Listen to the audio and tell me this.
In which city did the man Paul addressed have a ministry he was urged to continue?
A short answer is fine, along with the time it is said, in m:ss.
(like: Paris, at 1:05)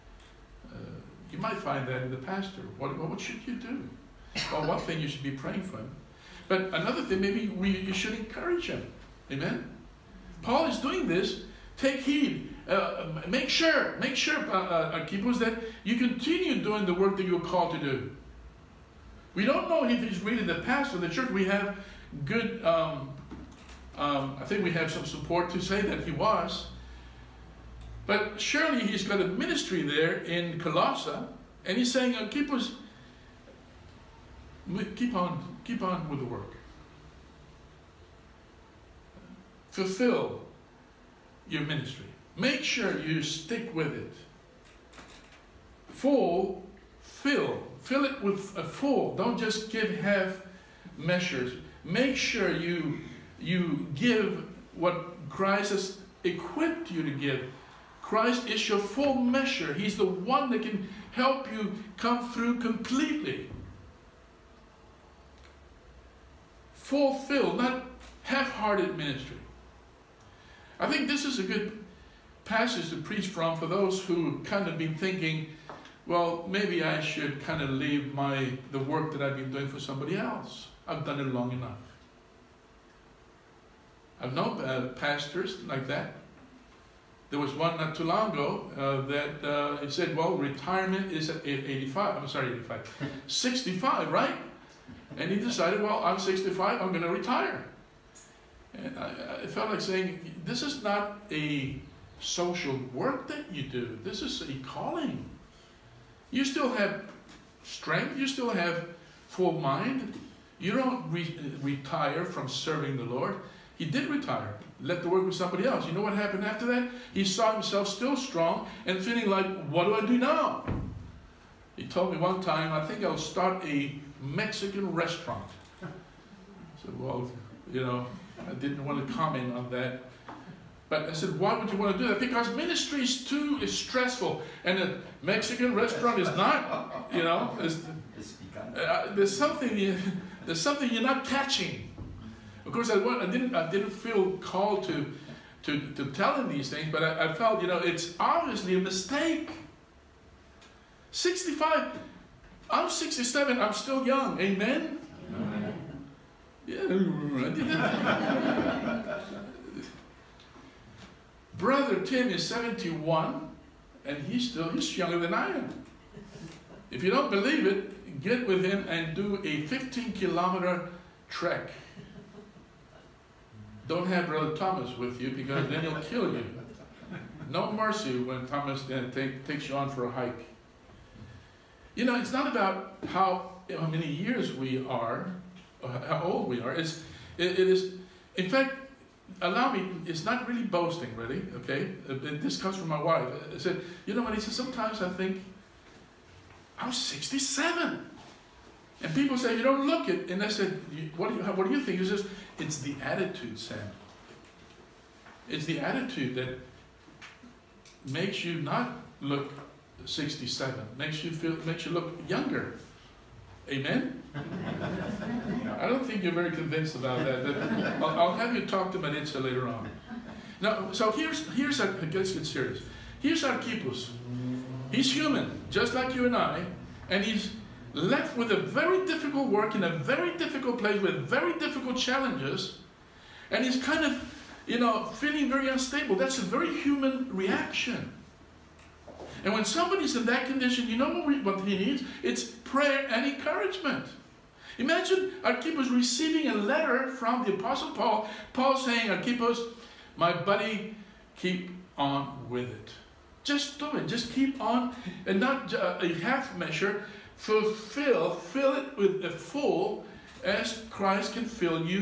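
Colossae, at 0:30.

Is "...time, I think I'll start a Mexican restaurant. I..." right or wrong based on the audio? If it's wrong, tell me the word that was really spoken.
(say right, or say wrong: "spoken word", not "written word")
right.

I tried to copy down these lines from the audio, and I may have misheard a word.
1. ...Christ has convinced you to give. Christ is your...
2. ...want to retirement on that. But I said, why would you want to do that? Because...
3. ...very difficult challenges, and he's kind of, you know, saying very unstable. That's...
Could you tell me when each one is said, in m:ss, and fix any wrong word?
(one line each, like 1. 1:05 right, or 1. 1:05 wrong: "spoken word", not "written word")
1. 0:55 wrong: "equipped", not "convinced"
2. 2:08 wrong: "comment", not "retirement"
3. 3:51 wrong: "feeling", not "saying".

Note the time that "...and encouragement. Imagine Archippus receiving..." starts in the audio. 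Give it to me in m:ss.
4:03.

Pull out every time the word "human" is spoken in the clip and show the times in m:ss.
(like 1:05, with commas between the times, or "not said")
3:45, 3:56.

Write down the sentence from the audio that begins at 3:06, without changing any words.
It's, it, it is, in fact, allow me, it's not really boasting, really, okay?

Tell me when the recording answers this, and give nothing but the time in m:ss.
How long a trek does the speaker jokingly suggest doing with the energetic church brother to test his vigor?
2:49.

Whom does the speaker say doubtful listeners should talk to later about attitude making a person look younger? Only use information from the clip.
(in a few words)
Manitza.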